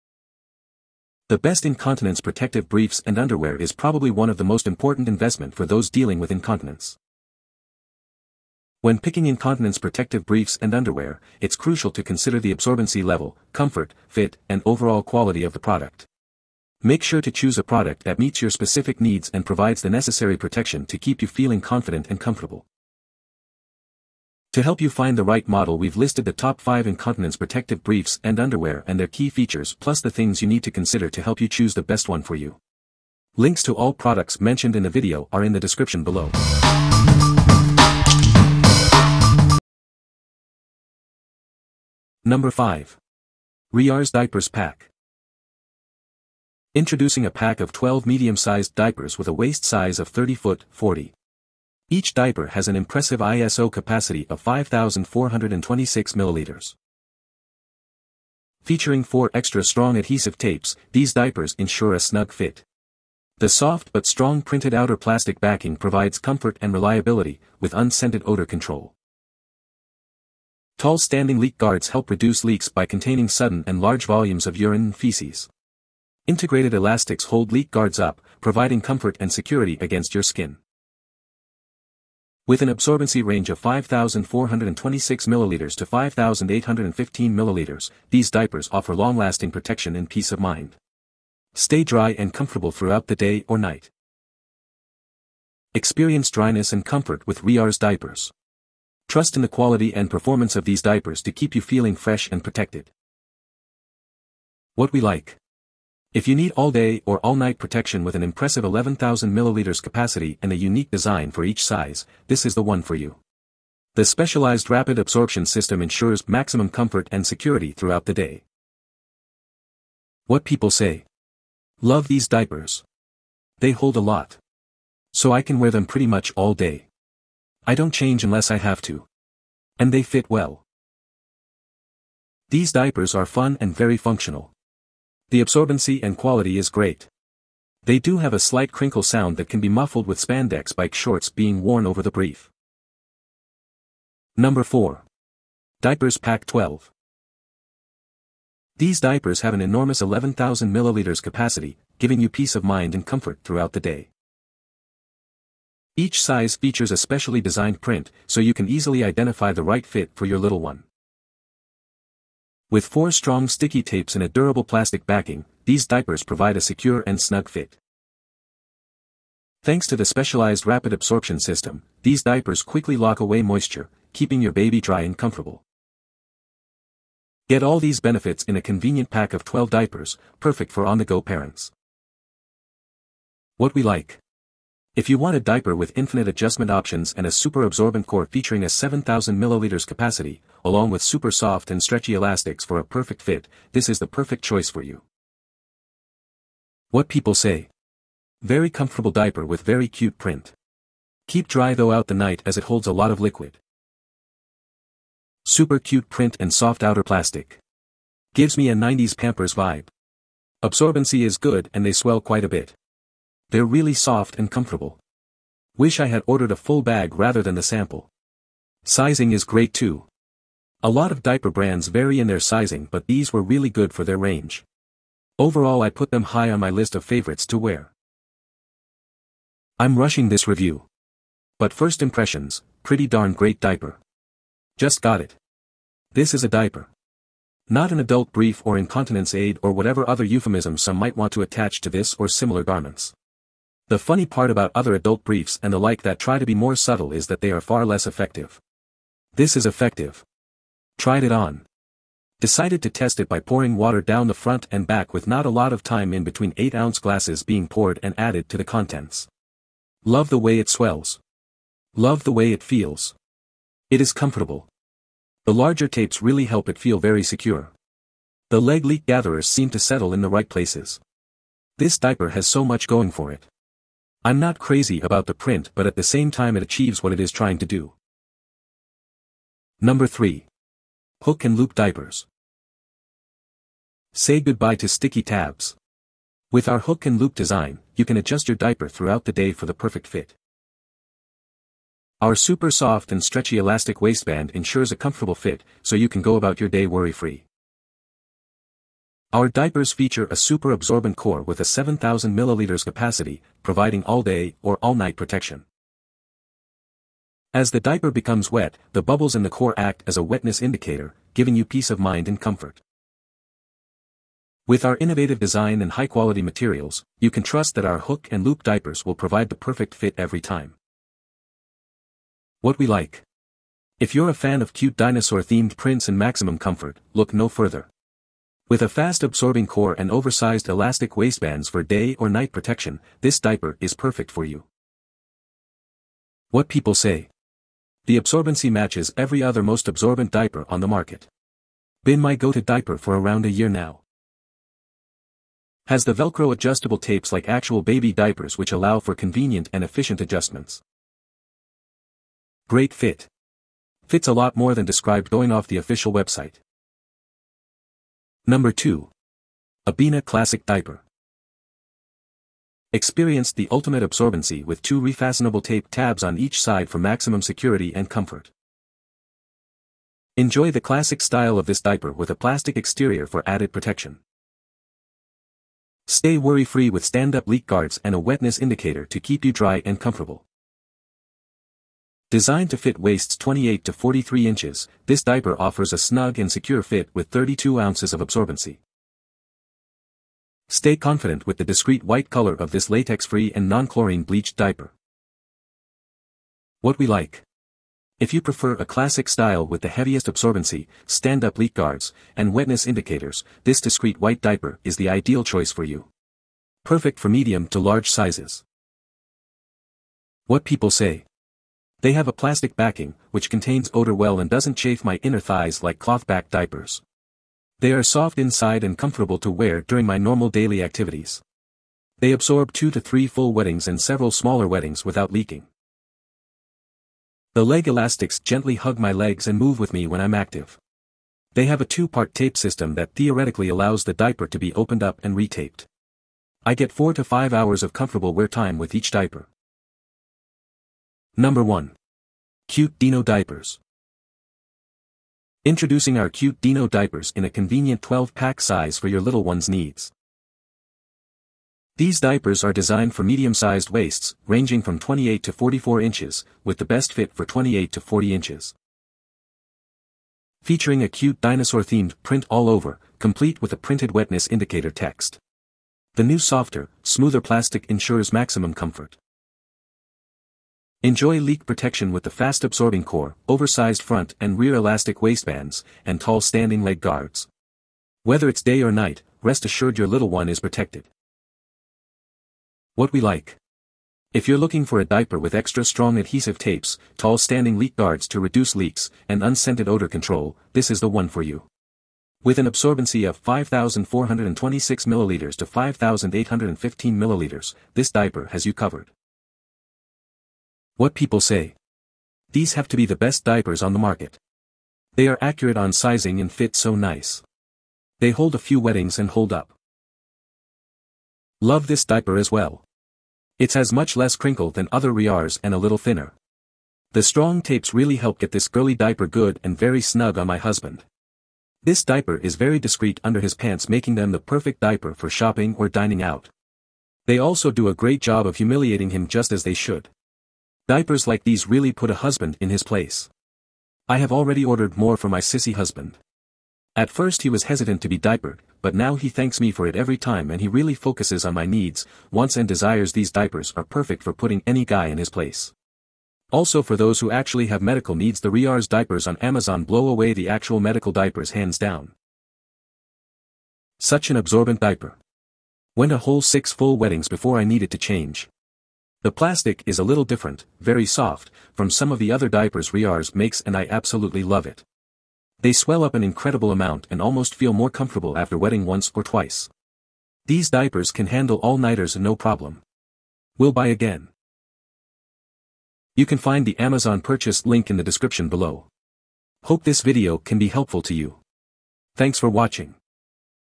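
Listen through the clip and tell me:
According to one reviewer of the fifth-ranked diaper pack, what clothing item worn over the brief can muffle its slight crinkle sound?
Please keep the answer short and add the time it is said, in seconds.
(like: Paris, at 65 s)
spandex bike shorts, at 140 s.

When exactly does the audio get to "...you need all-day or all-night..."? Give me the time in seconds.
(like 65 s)
106 s.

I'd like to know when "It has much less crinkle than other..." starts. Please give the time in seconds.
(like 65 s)
513 s.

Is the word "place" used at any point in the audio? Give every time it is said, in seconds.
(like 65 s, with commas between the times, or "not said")
270 s, 532 s, 545 s.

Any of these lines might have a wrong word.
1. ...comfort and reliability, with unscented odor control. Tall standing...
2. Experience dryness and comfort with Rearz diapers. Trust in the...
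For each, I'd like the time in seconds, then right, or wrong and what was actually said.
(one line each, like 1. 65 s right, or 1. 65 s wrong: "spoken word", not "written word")
1. 66 s right
2. 95 s right.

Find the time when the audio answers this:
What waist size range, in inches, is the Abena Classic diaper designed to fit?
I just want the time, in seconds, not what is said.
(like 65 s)
383 s.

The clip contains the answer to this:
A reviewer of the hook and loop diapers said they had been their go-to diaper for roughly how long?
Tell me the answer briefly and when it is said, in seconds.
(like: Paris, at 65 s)
around a year, at 343 s.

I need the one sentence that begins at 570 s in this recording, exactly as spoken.
These diapers can handle all-nighters no problem.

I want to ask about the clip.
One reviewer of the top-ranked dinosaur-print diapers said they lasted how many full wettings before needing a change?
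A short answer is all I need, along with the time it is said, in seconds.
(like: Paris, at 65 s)
6, at 556 s.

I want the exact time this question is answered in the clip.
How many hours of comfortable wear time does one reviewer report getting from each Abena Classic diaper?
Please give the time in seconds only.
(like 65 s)
436 s.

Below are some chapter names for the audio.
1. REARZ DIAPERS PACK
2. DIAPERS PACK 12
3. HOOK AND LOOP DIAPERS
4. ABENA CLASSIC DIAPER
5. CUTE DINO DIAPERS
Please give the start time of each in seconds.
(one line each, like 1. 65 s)
1. 40 s
2. 143 s
3. 278 s
4. 357 s
5. 440 s.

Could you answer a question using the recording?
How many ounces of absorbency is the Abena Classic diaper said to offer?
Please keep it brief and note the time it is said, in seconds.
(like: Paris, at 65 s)
32 ounces, at 387 s.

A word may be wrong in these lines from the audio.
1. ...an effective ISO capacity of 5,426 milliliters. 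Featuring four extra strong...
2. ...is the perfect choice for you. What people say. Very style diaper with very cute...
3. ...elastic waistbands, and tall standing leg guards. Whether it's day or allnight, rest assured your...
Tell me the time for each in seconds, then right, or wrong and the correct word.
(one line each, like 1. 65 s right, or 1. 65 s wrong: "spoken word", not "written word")
1. 52 s wrong: "impressive", not "effective"
2. 193 s wrong: "comfortable", not "style"
3. 474 s wrong: "night", not "allnight".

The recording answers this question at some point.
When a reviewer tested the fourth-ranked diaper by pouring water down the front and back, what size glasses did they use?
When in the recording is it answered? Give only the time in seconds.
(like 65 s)
256 s.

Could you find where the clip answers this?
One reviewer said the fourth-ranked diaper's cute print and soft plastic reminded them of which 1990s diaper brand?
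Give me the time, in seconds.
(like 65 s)
209 s.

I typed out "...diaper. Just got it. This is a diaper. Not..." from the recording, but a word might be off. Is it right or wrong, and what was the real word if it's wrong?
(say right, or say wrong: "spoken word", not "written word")
right.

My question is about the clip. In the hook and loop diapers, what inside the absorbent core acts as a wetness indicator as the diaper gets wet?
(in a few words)
bubbles.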